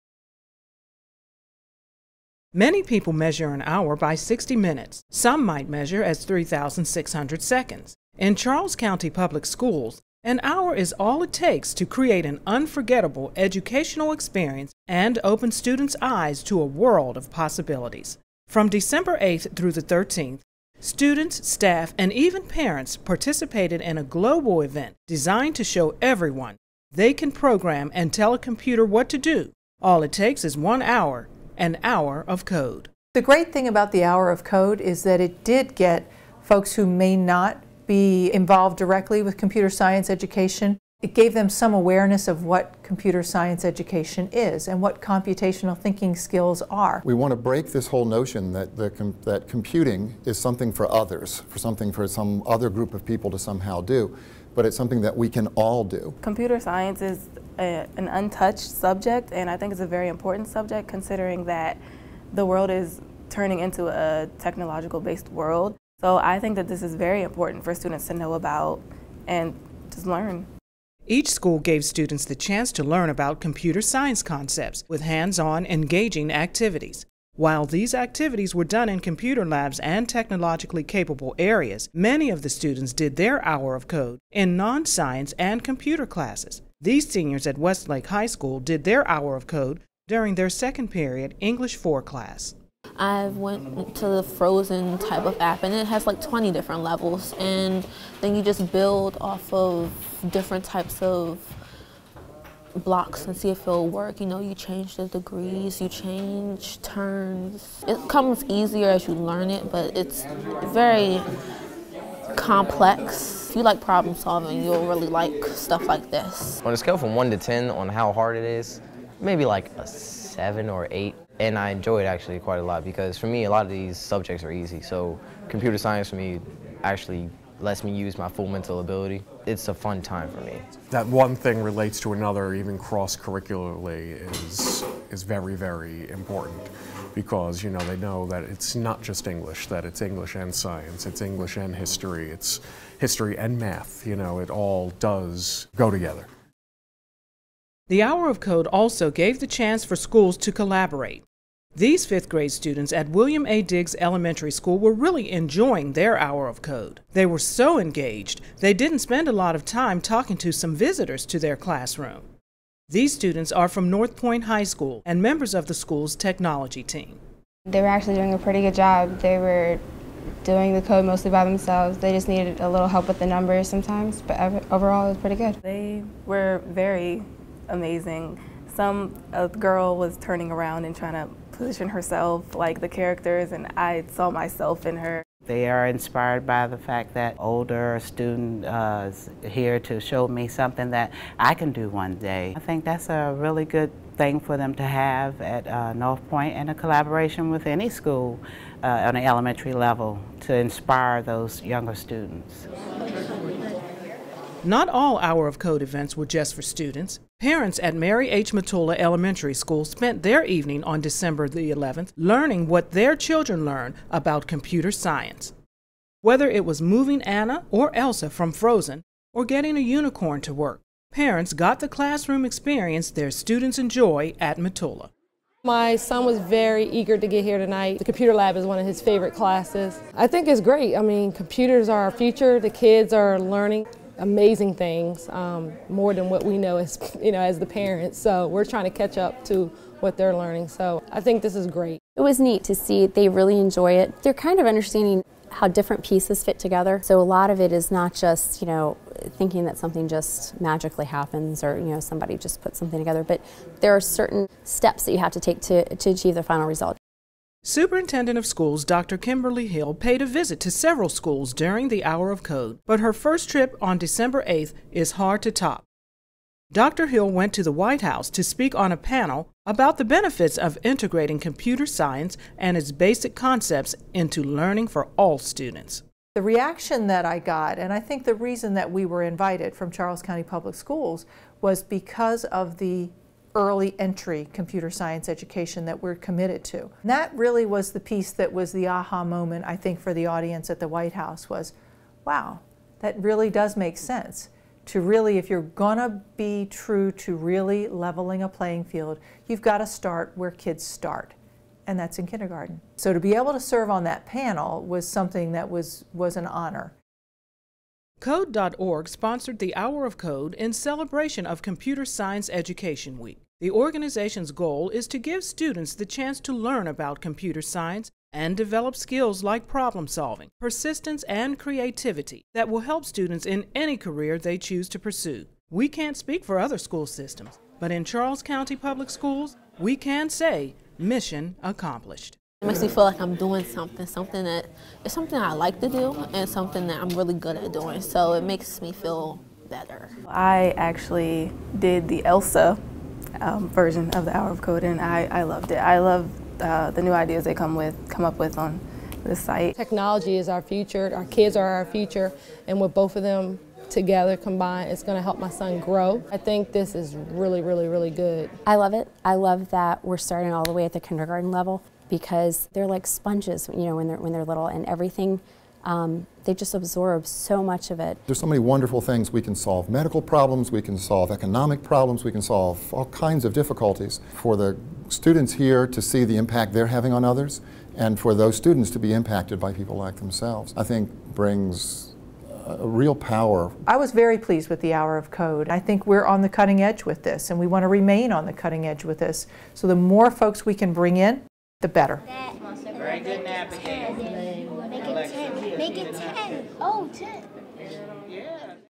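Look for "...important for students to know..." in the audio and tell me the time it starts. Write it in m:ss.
1:07.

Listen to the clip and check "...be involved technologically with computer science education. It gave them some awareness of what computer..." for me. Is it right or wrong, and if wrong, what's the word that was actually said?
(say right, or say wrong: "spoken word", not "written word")
wrong: "directly", not "technologically".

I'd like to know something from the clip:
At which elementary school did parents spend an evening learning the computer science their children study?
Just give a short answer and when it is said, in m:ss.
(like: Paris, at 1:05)
Mary H. Matula Elementary School, at 3:27.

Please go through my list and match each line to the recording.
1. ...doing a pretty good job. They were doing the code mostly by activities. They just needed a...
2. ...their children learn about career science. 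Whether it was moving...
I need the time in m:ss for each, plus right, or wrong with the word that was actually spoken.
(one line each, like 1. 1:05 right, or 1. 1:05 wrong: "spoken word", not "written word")
1. 2:48 wrong: "themselves", not "activities"
2. 3:32 wrong: "computer", not "career".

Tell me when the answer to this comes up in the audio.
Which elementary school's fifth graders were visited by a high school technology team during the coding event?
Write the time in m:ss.
2:33.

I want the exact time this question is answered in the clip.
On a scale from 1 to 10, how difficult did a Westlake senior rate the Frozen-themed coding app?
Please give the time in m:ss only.
1:59.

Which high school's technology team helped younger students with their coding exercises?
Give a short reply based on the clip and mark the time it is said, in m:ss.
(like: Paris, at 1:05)
North Point High School, at 2:43.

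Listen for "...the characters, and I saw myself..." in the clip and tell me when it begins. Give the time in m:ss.
3:02.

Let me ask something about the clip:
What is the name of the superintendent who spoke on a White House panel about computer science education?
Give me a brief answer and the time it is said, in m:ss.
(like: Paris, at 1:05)
Kimberly Hill, at 4:18.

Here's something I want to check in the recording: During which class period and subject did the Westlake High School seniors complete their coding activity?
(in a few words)
Second period English 4.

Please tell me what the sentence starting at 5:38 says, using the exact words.
So it makes me feel better.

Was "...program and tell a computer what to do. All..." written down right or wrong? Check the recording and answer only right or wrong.
right.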